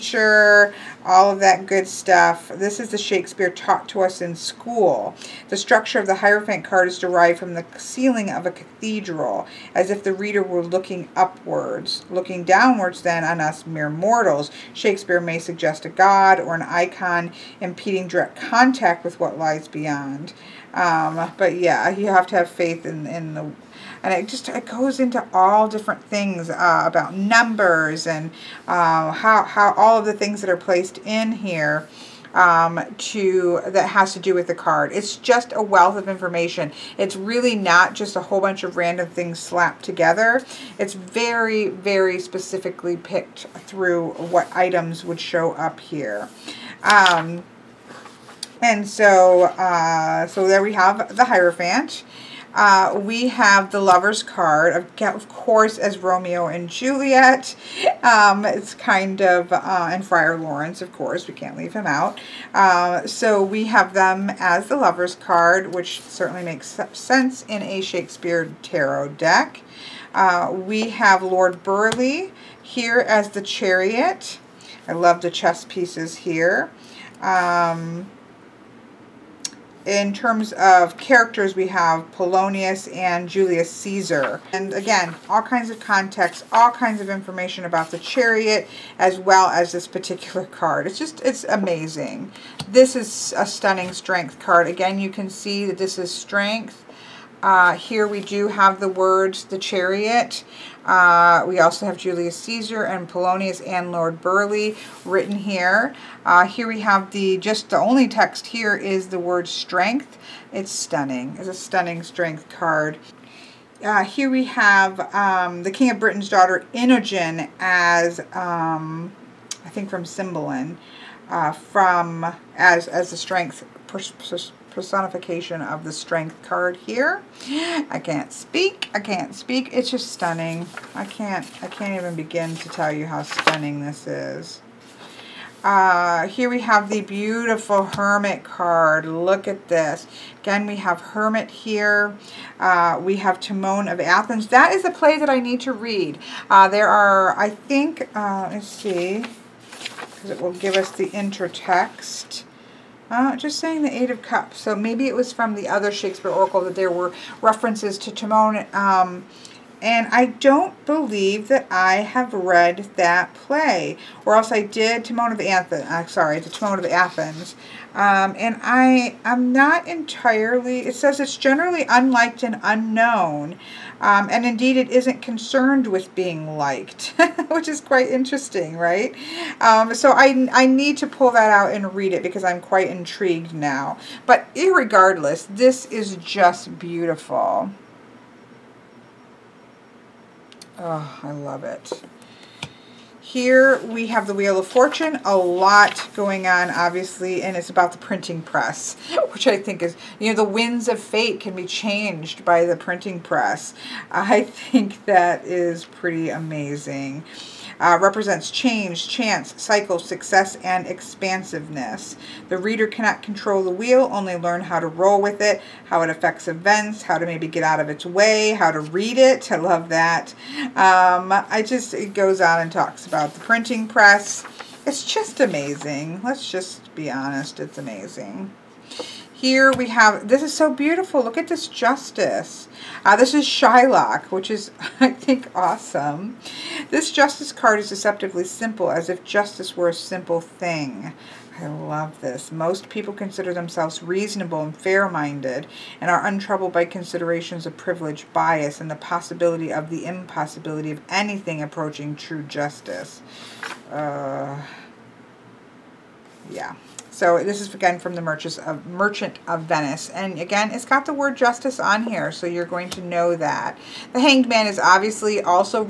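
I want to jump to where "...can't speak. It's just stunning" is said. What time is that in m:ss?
2:08.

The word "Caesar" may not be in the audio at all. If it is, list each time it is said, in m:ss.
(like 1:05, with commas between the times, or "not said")
1:23, 1:42.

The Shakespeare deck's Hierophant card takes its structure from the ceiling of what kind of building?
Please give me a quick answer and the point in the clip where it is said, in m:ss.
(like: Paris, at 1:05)
A cathedral, at 0:08.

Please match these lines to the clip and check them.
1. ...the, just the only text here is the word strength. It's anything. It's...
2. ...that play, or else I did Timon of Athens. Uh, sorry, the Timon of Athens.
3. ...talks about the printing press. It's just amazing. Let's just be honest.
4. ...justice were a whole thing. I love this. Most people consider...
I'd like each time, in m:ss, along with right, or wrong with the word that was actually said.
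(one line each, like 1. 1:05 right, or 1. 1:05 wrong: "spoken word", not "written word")
1. 1:47 wrong: "stunning", not "anything"
2. 2:42 right
3. 3:42 right
4. 3:59 wrong: "simple", not "whole".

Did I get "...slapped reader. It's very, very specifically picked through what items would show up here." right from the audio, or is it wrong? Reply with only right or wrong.
wrong.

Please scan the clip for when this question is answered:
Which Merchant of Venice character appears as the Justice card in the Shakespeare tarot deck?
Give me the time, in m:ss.
3:53.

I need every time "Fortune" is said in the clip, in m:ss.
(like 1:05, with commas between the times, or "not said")
3:14.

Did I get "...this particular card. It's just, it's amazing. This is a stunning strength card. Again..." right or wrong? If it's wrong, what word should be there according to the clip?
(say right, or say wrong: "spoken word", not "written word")
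right.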